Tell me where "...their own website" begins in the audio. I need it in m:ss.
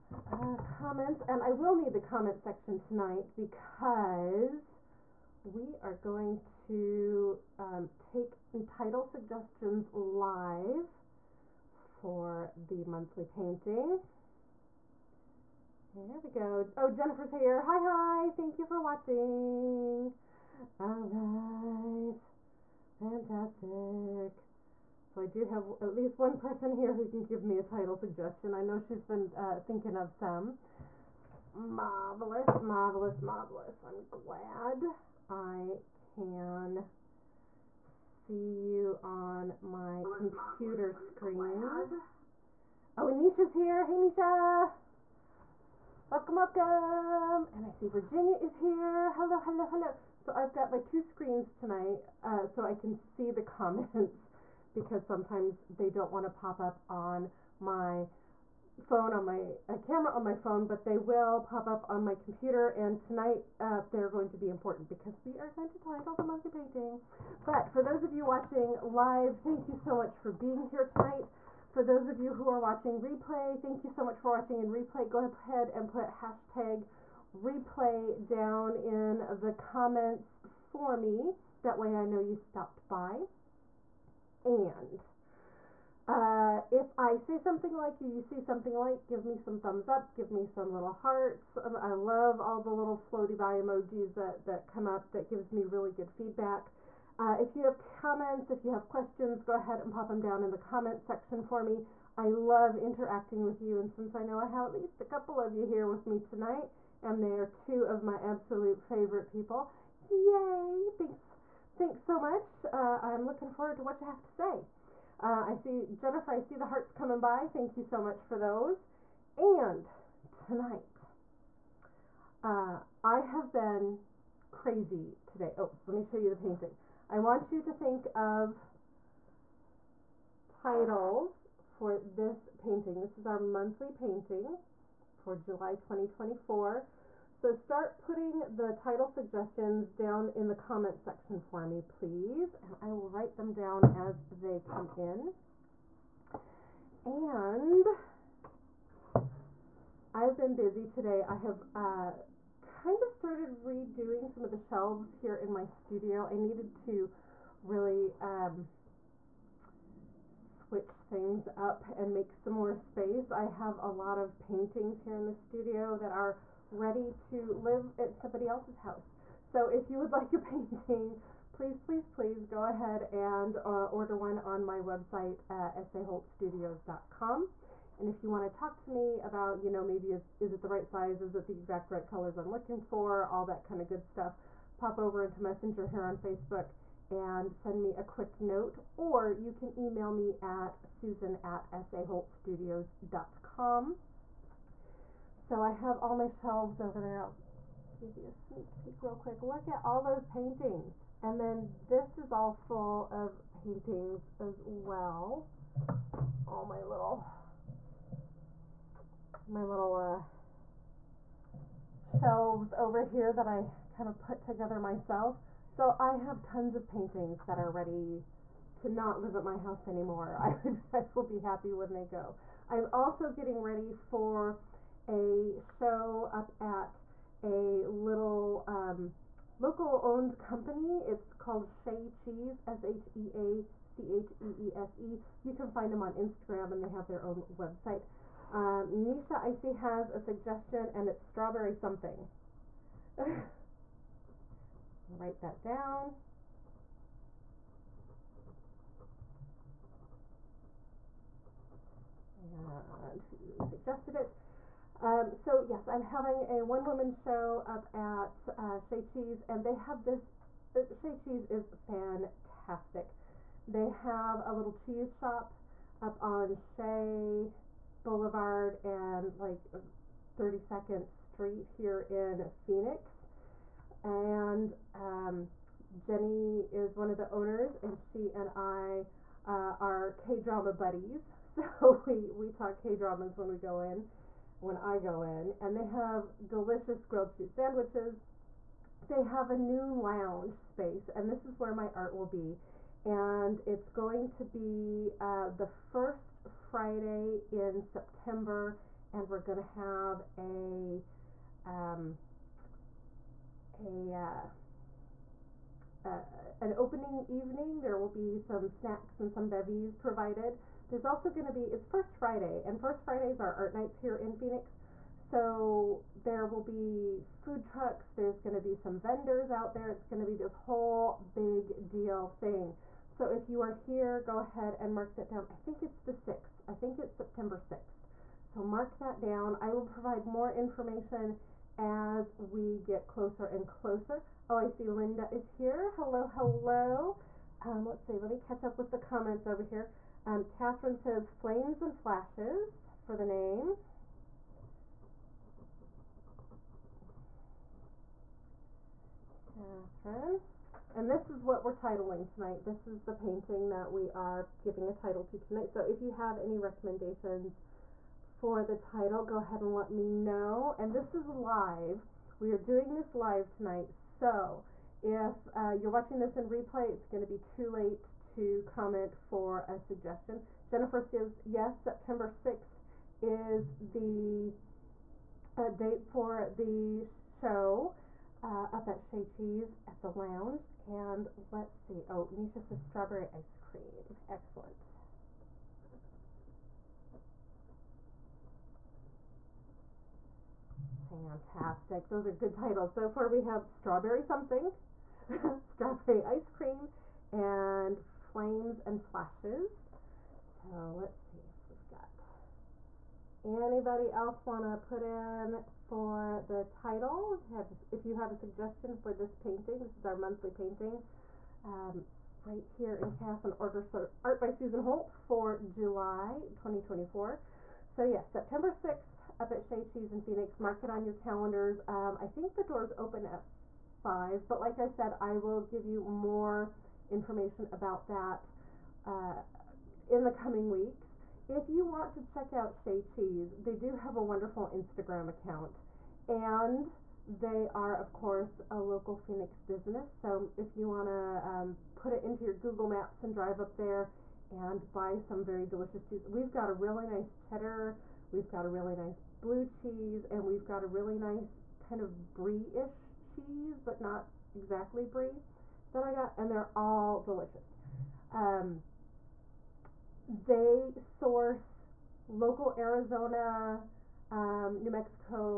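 3:57.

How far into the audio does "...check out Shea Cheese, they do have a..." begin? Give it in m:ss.
7:12.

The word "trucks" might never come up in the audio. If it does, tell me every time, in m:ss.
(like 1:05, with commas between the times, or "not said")
5:17.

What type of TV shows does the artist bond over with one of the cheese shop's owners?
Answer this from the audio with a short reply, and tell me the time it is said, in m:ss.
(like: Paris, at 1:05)
K dramas, at 4:40.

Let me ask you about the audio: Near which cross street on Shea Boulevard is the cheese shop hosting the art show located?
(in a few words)
32nd Street.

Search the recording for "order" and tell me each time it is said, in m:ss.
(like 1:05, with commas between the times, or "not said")
2:53, 6:53.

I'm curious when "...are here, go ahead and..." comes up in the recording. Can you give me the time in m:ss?
5:23.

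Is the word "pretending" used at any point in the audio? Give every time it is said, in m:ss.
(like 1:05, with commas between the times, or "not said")
not said.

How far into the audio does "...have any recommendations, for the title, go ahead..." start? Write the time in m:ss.
5:56.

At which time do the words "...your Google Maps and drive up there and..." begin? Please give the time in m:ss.
7:22.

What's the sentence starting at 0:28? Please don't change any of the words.
I know she's been uh, thinking of some.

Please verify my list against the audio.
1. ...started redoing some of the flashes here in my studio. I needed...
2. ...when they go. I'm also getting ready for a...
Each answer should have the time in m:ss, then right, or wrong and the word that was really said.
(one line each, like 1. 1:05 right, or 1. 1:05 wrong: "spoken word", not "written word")
1. 2:33 wrong: "shelves", not "flashes"
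2. 3:41 right.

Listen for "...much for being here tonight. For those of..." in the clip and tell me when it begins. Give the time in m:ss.
1:09.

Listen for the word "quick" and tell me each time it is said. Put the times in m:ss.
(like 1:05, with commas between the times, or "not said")
3:08, 3:19.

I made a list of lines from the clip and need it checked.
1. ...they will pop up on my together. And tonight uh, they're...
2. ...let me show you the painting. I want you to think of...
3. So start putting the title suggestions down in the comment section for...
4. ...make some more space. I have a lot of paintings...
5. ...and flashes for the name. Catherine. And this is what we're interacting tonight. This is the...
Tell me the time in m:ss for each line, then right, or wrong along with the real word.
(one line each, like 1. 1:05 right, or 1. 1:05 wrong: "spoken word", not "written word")
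1. 1:00 wrong: "computer", not "together"
2. 2:05 right
3. 2:17 right
4. 2:42 right
5. 5:41 wrong: "titling", not "interacting".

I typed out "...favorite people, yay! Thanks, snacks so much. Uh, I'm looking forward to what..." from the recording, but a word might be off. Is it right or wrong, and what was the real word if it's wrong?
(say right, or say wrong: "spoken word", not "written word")
wrong: "thanks", not "snacks".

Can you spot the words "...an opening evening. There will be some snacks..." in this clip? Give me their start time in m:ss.
5:06.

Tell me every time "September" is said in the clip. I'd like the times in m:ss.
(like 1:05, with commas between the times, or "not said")
4:57, 5:27, 6:11, 6:58.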